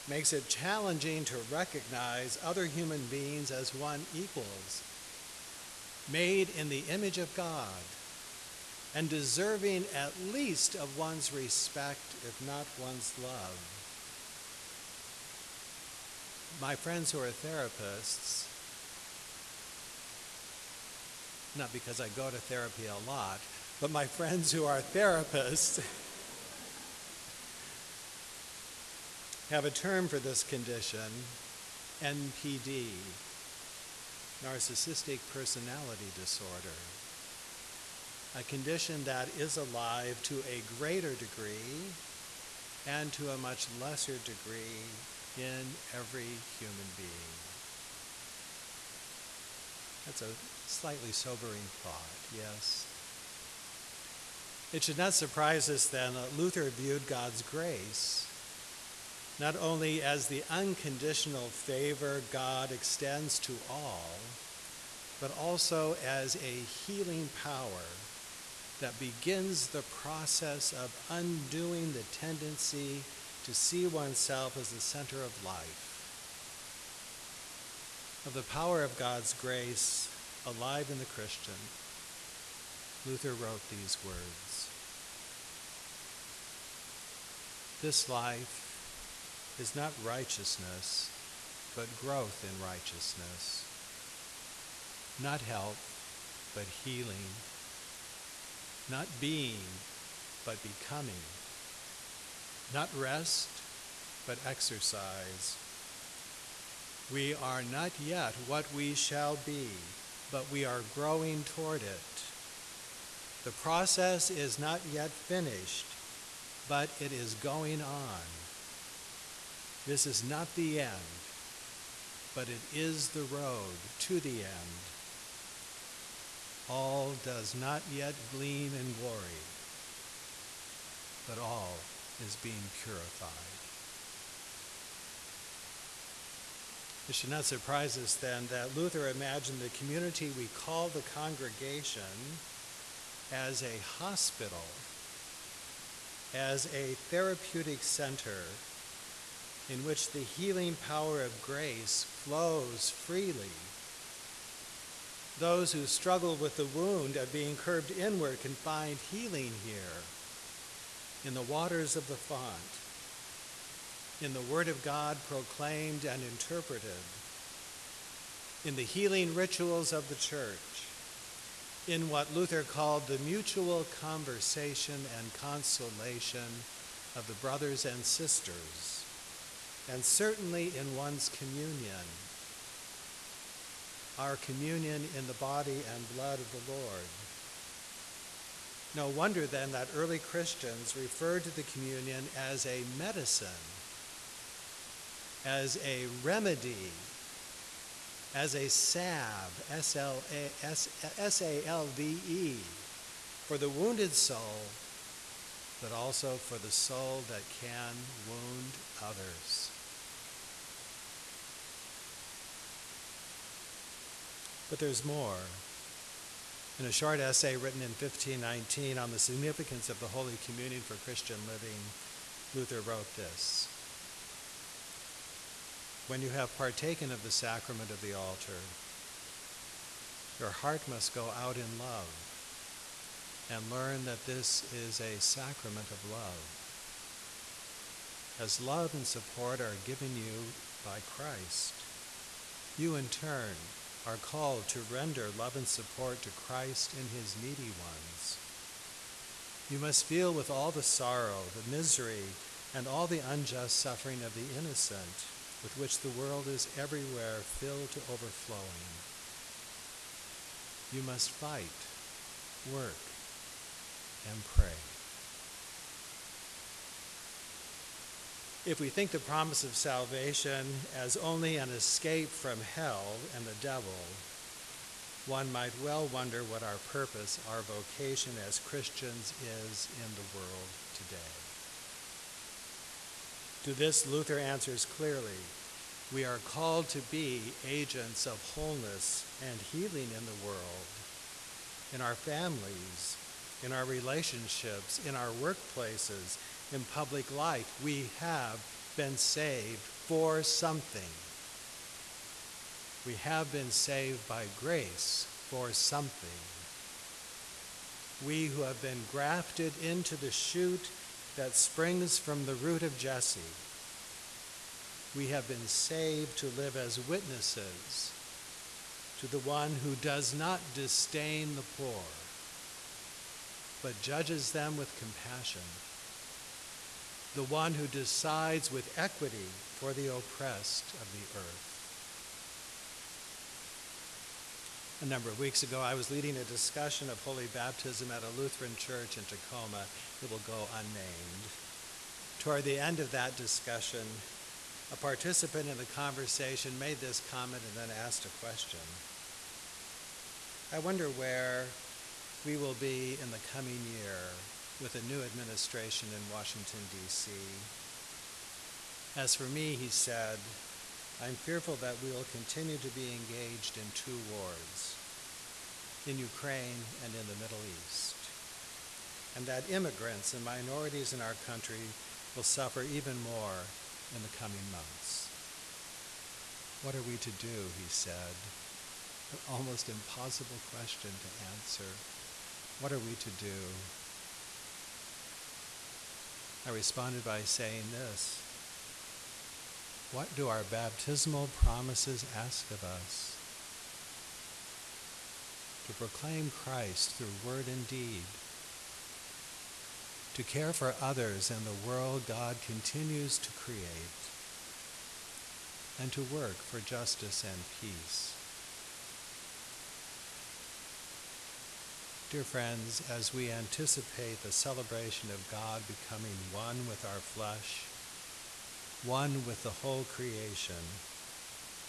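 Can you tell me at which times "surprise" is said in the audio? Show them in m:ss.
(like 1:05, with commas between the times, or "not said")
0:55, 2:17.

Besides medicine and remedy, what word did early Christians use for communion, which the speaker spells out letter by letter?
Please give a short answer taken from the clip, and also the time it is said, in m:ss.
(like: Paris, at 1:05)
salve, at 3:18.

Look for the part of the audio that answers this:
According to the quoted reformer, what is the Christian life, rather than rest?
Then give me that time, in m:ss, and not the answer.
1:44.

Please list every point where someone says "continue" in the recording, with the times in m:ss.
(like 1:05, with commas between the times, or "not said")
6:02, 6:42.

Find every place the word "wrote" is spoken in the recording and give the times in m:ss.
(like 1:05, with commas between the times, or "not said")
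1:23, 3:42.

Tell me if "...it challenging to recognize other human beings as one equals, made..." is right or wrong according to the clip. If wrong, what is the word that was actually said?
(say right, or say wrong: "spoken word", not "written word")
right.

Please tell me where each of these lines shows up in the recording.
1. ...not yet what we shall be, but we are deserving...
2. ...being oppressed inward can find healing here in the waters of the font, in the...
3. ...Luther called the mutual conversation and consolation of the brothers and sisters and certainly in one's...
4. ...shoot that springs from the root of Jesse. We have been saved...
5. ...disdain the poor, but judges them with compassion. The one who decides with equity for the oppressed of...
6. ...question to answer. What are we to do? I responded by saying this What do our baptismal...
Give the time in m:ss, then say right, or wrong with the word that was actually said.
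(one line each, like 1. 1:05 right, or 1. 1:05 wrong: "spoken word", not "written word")
1. 1:47 wrong: "growing", not "deserving"
2. 2:37 wrong: "curved", not "oppressed"
3. 2:52 right
4. 5:10 right
5. 5:20 right
6. 6:20 right.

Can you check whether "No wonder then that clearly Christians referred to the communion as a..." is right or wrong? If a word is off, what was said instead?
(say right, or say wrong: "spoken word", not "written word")
wrong: "early", not "clearly".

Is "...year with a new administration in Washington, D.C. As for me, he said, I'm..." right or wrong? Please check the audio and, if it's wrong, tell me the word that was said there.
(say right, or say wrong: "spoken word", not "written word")
right.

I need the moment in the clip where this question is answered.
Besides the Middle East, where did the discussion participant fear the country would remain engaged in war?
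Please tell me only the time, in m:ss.
6:06.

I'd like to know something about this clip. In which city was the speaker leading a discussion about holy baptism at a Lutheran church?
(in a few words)
Tacoma.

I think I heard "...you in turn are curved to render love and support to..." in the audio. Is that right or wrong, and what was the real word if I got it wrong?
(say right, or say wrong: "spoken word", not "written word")
wrong: "called", not "curved".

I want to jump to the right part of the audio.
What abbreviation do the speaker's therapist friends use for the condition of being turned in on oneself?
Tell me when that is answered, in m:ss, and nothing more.
0:32.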